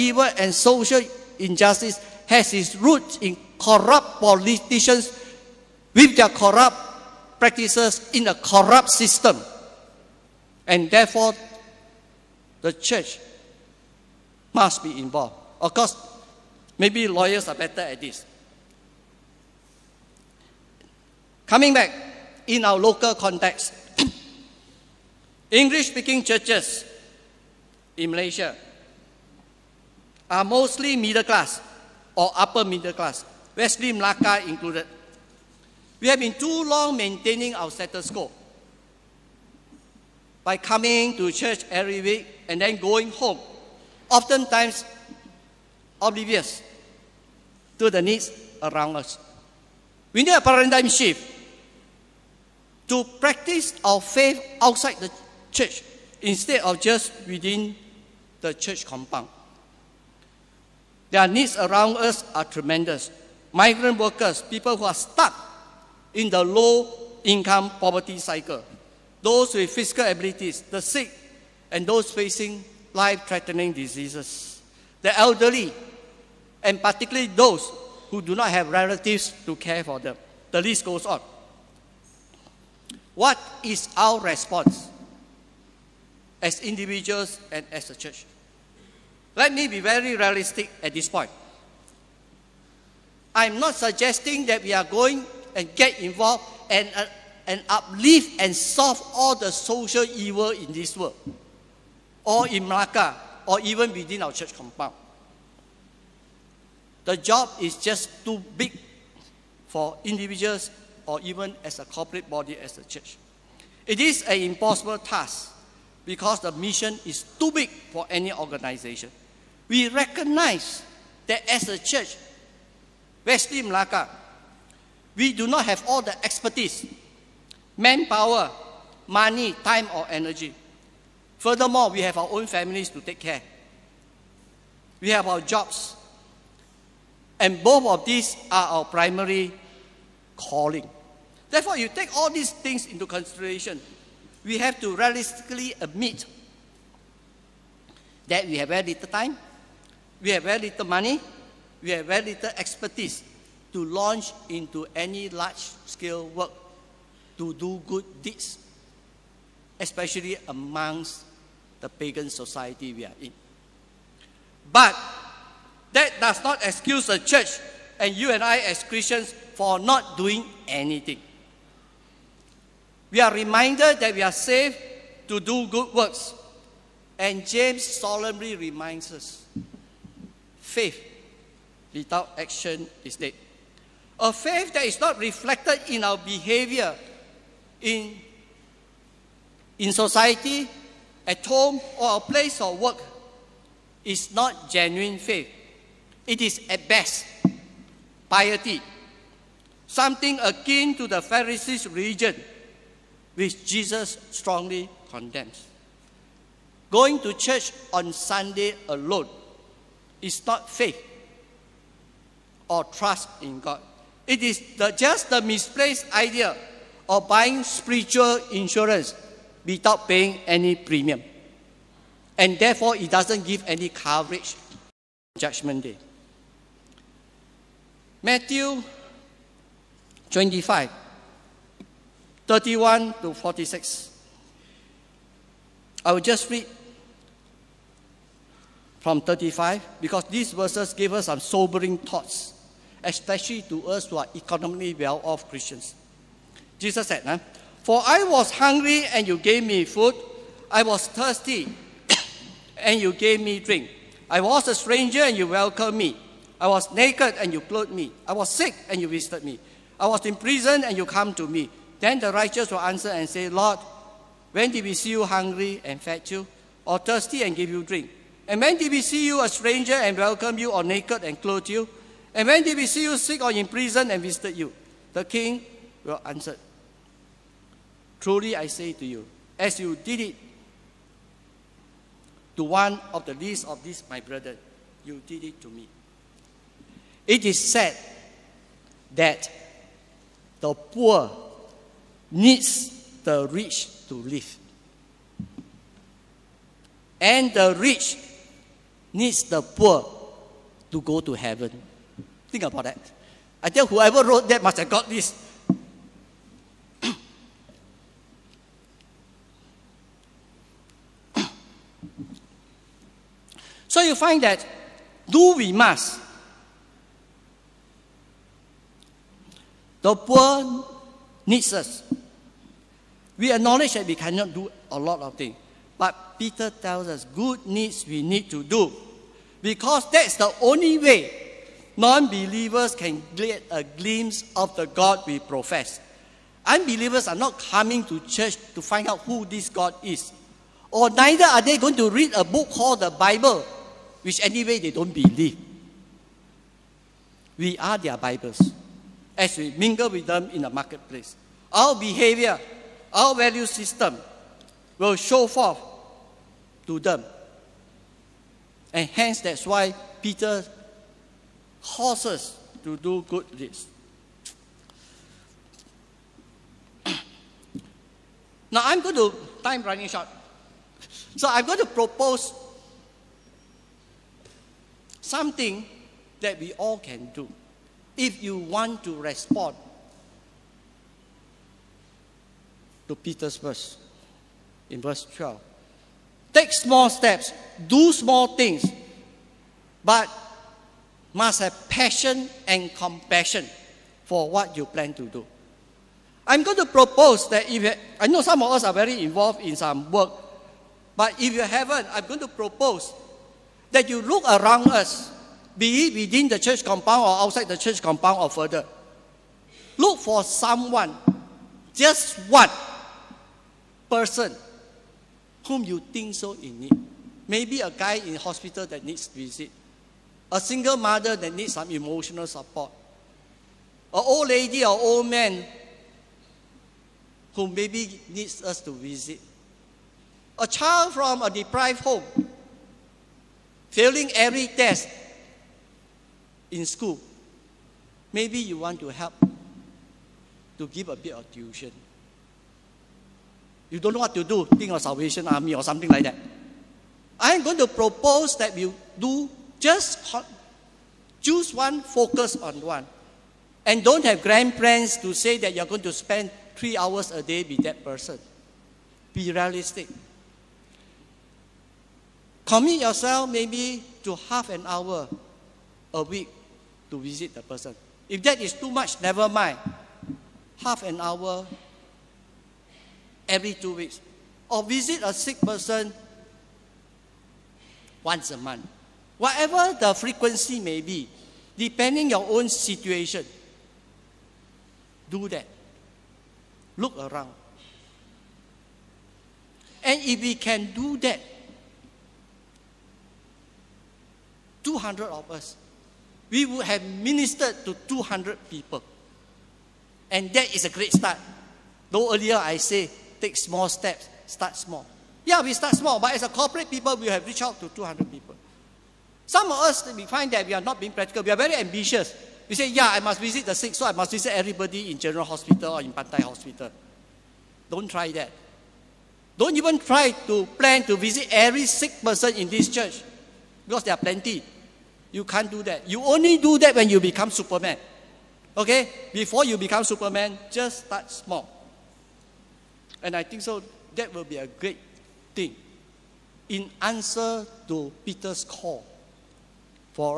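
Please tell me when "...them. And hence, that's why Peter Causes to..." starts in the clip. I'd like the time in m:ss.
5:56.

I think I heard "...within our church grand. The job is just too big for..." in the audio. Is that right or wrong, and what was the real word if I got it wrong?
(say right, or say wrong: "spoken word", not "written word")
wrong: "compound", not "grand".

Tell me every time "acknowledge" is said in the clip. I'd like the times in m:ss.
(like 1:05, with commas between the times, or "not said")
5:23.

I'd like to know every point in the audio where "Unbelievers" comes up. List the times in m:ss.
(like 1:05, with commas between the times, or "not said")
5:36.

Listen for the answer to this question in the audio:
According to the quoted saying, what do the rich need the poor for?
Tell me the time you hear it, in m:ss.
5:00.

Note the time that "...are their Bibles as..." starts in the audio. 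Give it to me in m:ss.
5:47.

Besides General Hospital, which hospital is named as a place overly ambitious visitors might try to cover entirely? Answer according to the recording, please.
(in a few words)
Pantai Hospital.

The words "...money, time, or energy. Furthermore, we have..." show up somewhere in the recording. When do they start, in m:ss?
2:09.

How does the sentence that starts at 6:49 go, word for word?
Look for someone, just one person whom you think so in need.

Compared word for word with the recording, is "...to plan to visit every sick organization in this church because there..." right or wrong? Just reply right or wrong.
wrong.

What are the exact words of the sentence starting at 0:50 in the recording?
We need a paradigm shift to practice our faith outside the church instead of just within the church compound.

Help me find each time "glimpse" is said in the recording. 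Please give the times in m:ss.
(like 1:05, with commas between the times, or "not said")
5:33.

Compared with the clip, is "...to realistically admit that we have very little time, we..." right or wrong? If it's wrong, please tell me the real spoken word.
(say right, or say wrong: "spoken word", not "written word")
right.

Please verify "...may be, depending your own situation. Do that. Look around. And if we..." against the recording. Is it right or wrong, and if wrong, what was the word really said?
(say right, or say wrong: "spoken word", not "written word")
right.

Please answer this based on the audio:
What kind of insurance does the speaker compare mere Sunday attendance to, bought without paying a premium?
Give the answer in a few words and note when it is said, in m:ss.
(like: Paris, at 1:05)
spiritual insurance, at 3:37.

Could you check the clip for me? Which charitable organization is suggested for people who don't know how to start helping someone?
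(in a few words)
Salvation Army.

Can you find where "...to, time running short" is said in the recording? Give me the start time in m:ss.
6:09.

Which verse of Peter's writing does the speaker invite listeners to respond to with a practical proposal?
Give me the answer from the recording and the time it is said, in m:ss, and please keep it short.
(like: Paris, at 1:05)
verse 12, at 6:25.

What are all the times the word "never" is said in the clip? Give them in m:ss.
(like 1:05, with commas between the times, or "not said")
7:49.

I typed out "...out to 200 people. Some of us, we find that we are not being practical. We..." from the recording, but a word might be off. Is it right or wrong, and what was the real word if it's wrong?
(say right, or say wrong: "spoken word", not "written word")
right.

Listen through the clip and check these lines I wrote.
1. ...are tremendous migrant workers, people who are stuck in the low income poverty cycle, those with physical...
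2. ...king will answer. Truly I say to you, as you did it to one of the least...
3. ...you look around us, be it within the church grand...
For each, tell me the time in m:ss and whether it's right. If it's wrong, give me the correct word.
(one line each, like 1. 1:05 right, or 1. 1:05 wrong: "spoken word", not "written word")
1. 1:02 right
2. 4:35 right
3. 6:44 wrong: "compound", not "grand".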